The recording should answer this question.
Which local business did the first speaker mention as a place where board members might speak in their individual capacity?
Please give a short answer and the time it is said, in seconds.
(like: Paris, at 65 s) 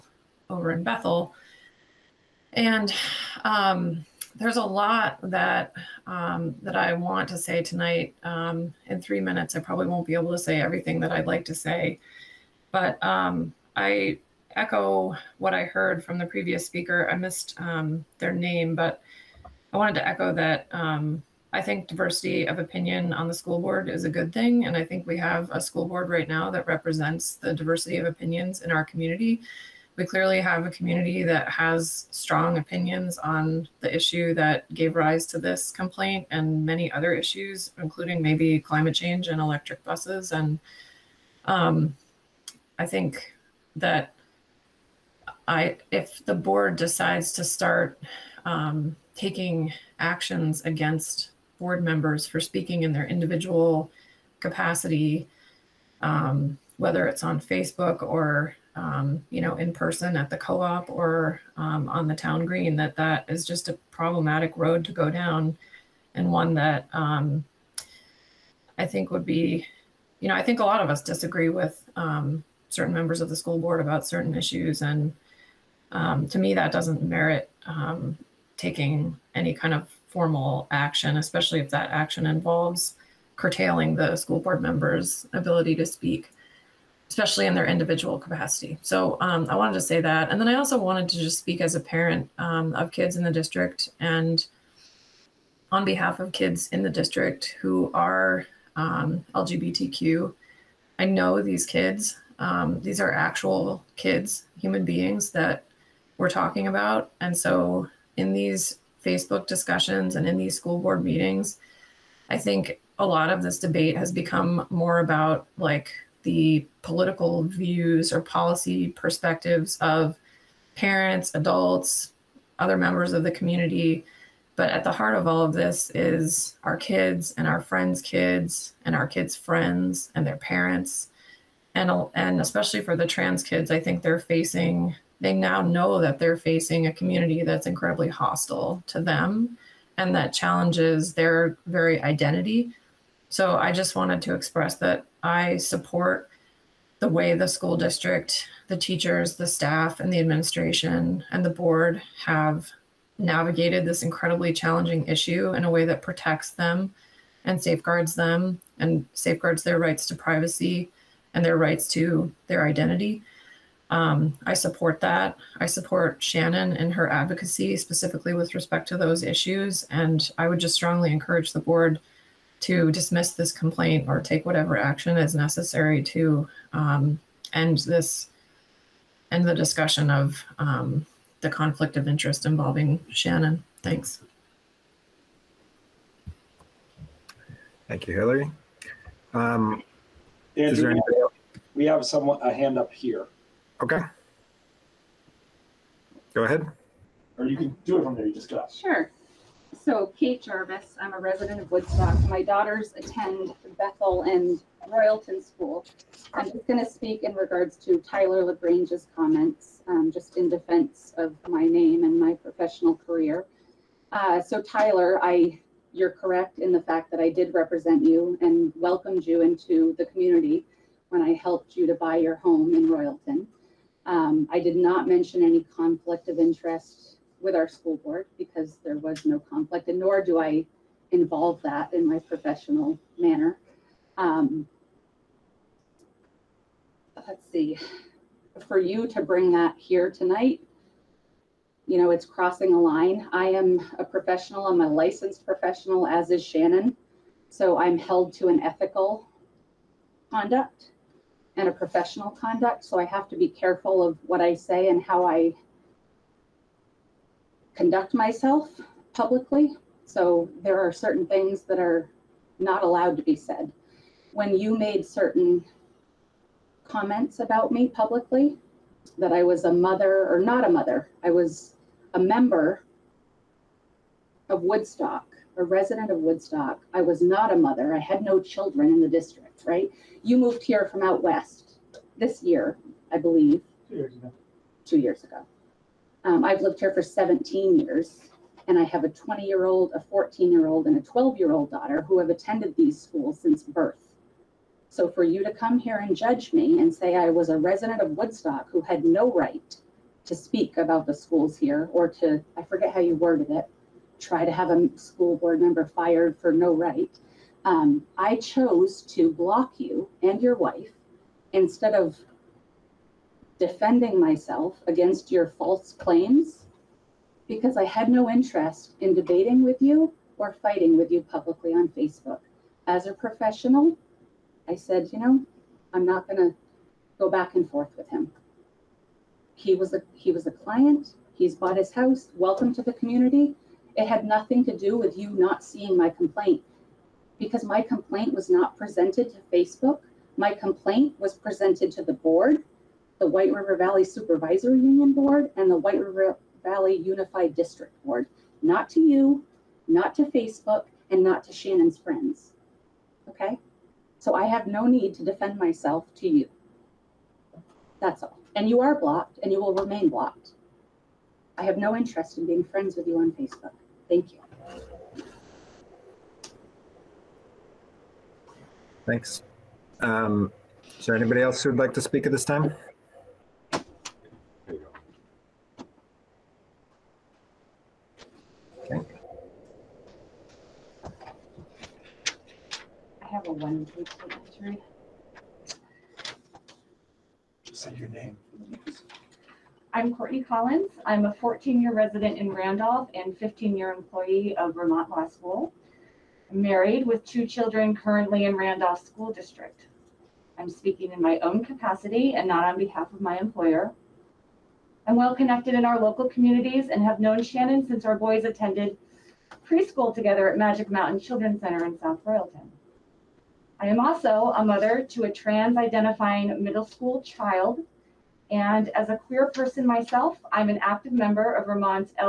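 the co-op, at 60 s.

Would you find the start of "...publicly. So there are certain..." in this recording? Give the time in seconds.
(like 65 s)
259 s.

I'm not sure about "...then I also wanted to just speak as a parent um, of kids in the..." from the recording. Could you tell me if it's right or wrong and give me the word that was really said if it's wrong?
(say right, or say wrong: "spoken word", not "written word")
right.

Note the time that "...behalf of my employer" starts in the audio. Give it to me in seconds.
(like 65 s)
402 s.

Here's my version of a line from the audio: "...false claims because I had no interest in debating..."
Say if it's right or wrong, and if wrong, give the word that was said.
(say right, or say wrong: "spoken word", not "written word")
right.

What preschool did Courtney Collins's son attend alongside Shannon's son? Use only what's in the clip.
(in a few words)
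Magic Mountain Children's Center.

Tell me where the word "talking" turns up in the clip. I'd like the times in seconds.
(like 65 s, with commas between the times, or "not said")
106 s.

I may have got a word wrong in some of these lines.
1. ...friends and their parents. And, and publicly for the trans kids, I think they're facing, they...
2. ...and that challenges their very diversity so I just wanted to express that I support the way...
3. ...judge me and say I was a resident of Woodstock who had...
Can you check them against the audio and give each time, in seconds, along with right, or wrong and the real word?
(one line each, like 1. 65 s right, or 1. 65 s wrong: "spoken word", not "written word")
1. 129 s wrong: "especially", not "publicly"
2. 139 s wrong: "identity", not "diversity"
3. 296 s right.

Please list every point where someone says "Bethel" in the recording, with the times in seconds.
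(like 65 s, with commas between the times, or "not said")
0 s, 203 s.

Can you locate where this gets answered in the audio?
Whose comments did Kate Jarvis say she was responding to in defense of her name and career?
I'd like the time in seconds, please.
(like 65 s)
207 s.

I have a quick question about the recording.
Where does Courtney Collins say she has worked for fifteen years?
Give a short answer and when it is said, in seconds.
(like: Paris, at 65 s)
Vermont Law School, at 394 s.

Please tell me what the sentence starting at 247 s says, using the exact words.
So I'm held to an ethical conduct and a professional conduct.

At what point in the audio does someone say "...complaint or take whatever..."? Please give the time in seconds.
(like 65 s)
173 s.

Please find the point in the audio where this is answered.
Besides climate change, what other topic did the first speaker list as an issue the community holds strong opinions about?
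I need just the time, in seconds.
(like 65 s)
39 s.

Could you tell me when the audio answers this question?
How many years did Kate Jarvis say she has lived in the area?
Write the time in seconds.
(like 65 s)
287 s.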